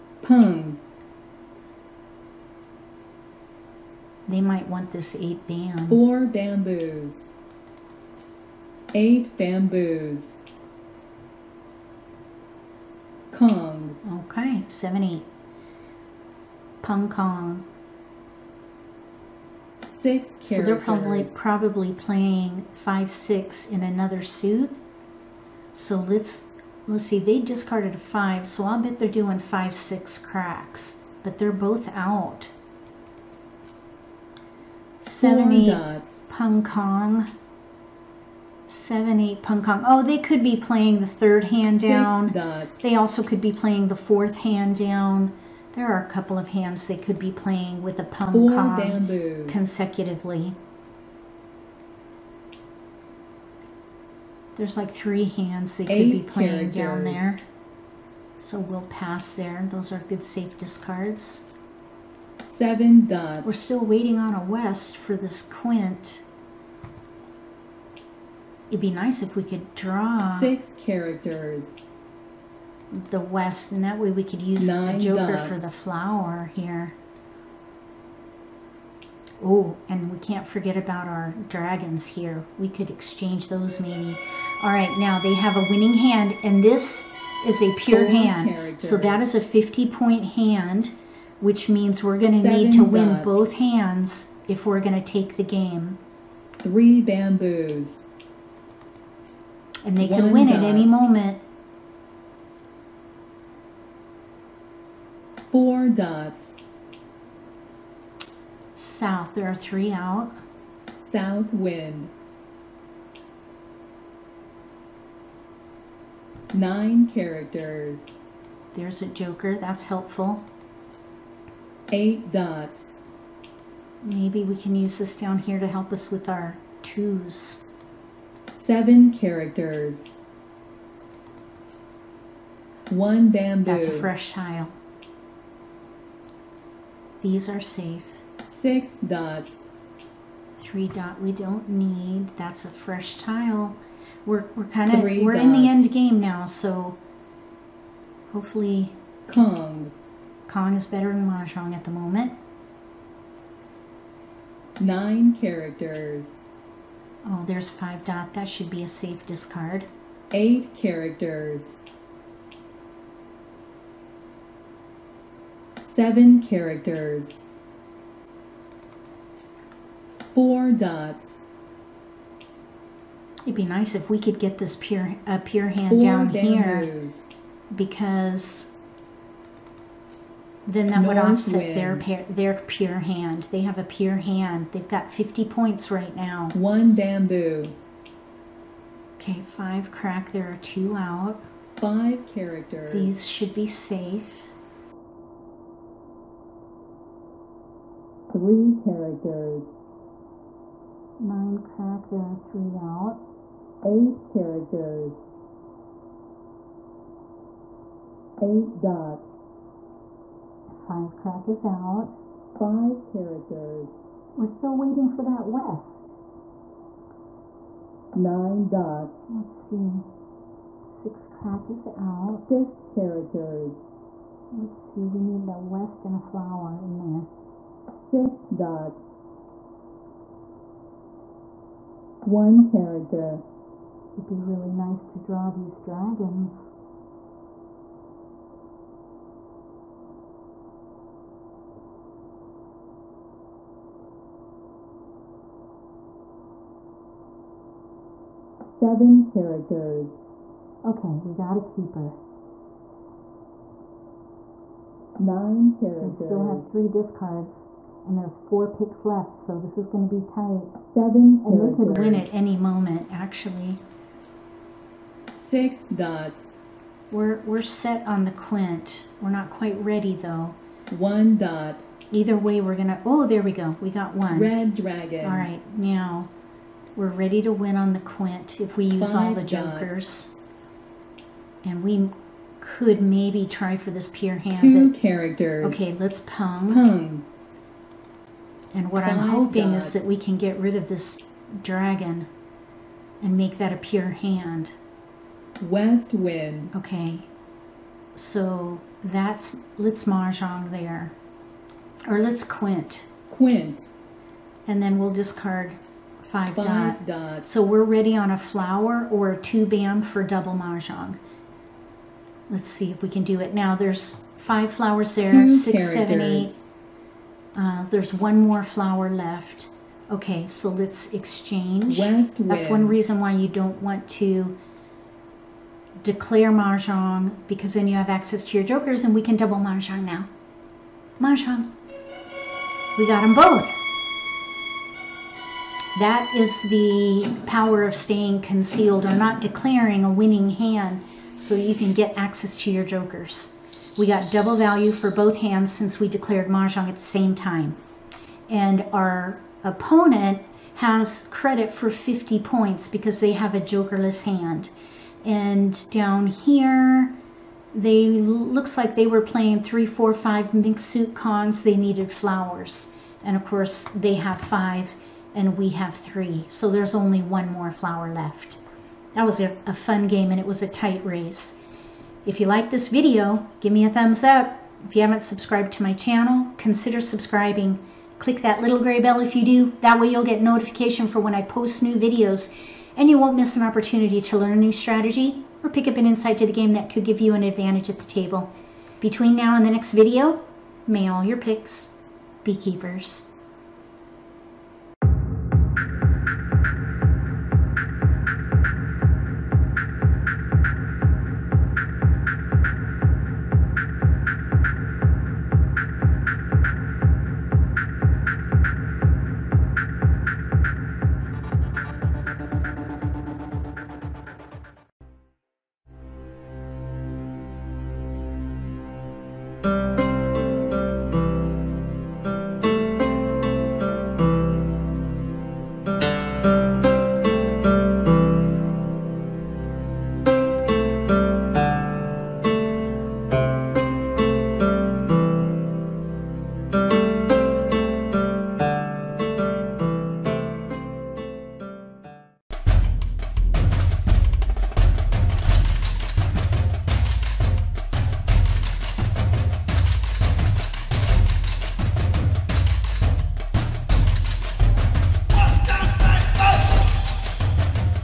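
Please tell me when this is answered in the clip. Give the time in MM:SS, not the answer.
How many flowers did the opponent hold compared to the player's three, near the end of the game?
06:03.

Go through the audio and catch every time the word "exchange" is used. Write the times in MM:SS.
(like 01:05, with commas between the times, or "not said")
01:22, 05:21.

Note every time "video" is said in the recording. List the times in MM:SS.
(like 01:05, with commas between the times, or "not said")
06:12, 06:21, 06:29.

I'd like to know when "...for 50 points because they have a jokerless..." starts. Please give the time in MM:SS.
05:51.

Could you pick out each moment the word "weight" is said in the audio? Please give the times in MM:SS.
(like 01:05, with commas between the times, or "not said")
not said.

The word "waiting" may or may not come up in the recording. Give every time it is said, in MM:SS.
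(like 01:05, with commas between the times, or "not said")
01:03, 03:34.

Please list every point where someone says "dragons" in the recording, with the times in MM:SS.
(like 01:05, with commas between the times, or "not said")
01:21, 03:55, 04:34, 04:51.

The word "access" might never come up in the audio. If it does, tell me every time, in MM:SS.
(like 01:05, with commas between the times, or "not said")
05:28, 05:42.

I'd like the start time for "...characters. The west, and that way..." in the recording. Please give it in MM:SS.
01:10.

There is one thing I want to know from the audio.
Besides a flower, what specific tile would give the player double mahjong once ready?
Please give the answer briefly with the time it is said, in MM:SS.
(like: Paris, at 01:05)
Two bam, at 05:09.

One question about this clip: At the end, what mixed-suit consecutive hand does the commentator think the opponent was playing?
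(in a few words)
Three, four, five mixed suit.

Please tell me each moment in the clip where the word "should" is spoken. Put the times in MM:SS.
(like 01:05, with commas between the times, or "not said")
02:38, 03:13.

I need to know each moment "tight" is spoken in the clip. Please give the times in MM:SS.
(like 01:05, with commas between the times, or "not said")
04:20, 06:10.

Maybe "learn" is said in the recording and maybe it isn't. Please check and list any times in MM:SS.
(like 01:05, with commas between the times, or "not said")
06:24.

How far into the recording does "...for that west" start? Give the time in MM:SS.
03:35.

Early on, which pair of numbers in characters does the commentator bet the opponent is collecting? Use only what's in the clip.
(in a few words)
Five six cracks.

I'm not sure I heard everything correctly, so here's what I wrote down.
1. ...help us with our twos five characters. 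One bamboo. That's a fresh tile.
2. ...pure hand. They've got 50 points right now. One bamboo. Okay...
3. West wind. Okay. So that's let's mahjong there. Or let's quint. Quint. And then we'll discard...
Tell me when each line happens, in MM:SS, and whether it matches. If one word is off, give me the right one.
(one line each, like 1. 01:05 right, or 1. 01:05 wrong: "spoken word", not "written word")
1. 02:05 wrong: "seven", not "five"
2. 03:03 right
3. 04:55 right.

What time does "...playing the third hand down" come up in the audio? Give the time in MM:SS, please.
00:40.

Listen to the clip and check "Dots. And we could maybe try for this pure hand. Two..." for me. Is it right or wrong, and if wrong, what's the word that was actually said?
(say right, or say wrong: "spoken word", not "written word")
right.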